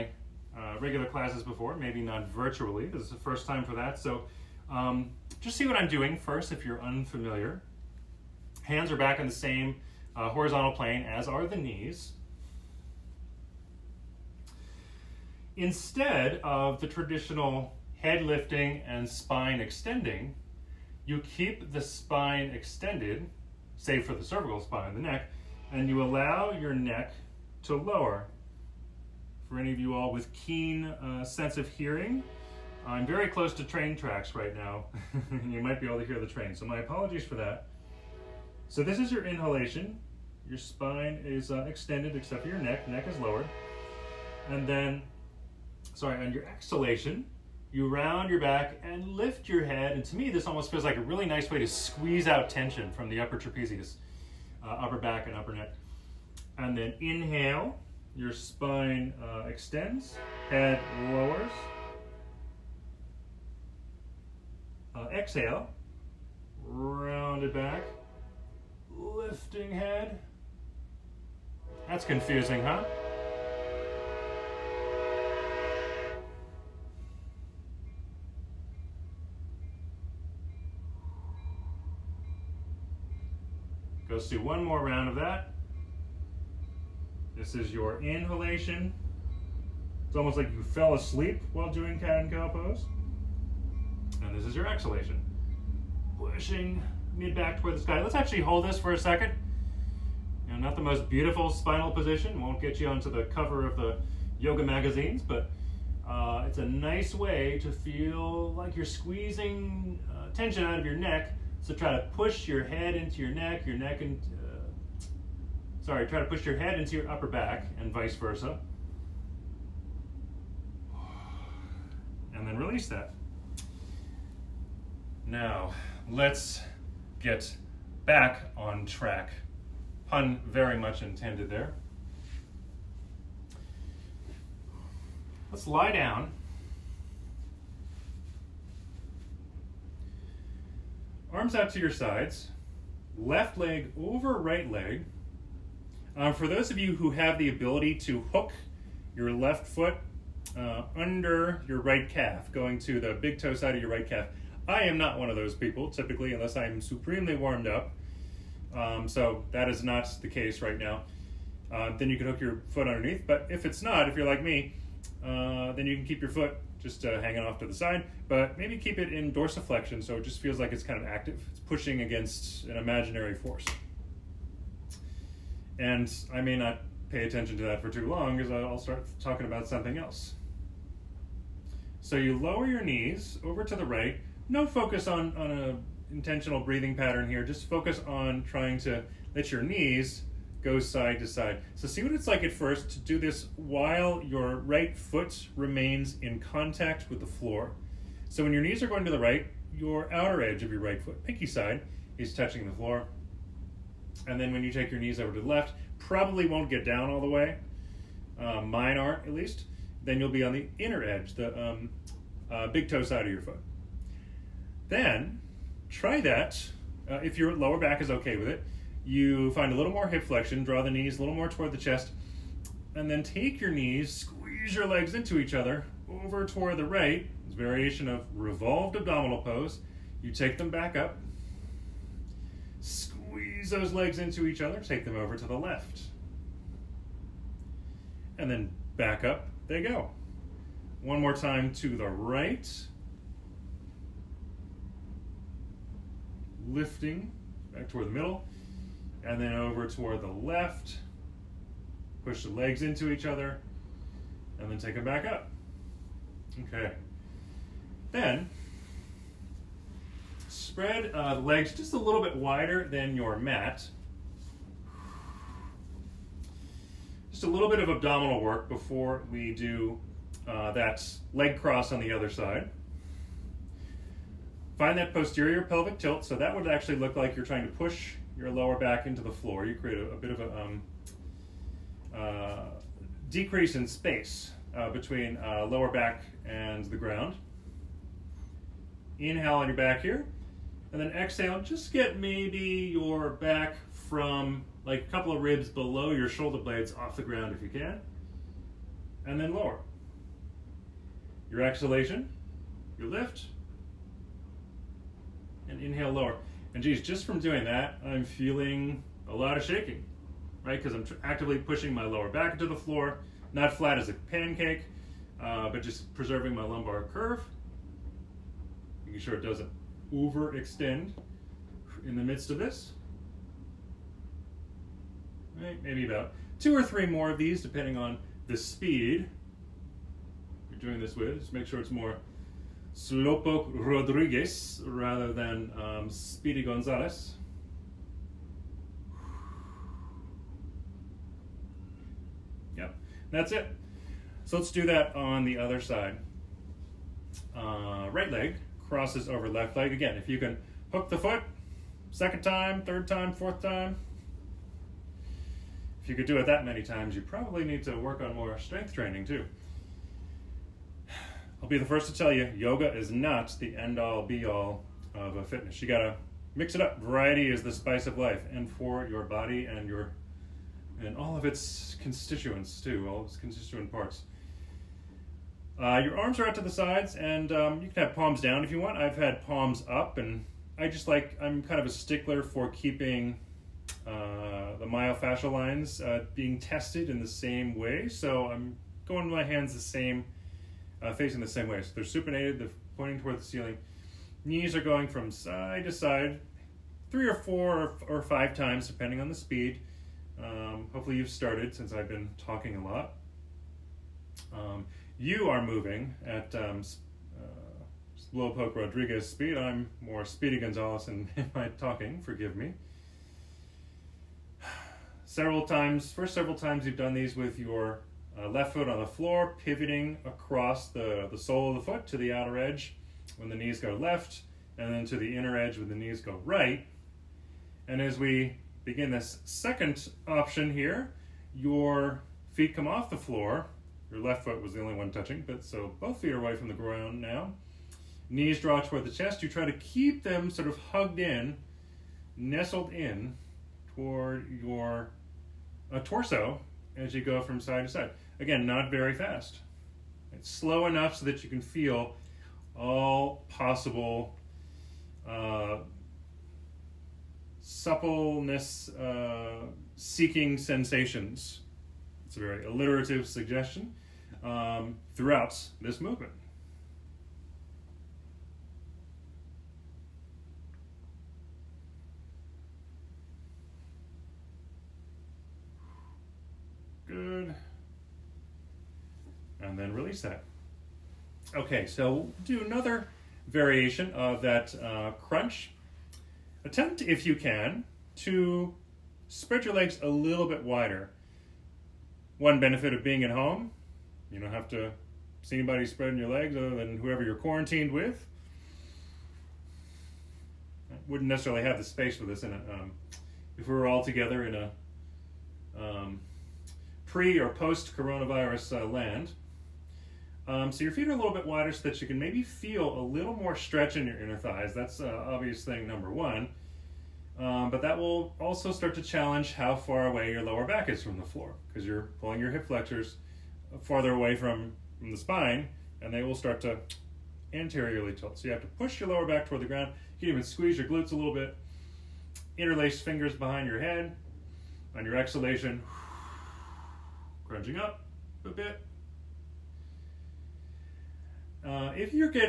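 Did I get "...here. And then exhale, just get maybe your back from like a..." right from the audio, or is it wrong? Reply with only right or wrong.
right.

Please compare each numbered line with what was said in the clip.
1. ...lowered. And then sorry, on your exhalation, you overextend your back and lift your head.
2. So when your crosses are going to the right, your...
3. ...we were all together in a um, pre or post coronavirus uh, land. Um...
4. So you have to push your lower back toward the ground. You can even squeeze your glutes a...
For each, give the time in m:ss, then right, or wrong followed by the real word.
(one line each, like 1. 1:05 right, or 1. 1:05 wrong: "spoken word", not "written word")
1. 0:43 wrong: "round", not "overextend"
2. 3:18 wrong: "knees", not "crosses"
3. 8:23 right
4. 8:48 right.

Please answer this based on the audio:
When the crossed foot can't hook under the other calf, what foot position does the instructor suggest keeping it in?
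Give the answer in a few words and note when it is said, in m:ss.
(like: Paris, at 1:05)
dorsiflexion, at 2:49.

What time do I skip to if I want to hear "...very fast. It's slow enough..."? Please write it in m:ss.
7:28.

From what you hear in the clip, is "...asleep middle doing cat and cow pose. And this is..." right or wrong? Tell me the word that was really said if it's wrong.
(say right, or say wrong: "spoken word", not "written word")
wrong: "while", not "middle".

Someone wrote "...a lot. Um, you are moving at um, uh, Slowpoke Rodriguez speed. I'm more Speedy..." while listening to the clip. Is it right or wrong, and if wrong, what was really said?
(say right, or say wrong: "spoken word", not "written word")
right.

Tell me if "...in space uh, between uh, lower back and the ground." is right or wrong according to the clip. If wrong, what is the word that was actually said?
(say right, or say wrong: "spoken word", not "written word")
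right.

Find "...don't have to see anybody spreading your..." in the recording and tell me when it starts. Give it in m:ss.
8:14.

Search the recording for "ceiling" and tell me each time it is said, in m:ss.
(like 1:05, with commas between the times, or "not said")
6:33.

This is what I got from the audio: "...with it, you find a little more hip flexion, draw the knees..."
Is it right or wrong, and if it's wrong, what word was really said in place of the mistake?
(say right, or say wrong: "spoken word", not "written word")
right.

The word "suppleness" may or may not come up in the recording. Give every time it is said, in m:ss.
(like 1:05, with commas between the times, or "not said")
7:37.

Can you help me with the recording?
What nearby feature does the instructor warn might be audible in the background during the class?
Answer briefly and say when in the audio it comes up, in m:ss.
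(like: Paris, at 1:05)
train tracks, at 0:33.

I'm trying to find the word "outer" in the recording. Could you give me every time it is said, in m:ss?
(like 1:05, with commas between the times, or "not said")
3:20, 7:02.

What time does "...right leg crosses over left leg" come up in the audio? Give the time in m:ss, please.
5:48.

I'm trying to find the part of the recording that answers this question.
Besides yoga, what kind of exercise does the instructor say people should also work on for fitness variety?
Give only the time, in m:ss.
5:58.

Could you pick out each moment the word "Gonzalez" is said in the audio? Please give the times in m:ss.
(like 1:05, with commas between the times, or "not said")
5:36, 6:50.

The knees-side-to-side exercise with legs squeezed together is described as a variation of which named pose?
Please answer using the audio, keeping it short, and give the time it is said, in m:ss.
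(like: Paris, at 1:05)
revolved abdominal pose, at 3:48.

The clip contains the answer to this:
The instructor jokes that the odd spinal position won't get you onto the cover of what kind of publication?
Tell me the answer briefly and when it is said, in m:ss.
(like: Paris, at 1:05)
yoga magazines, at 1:44.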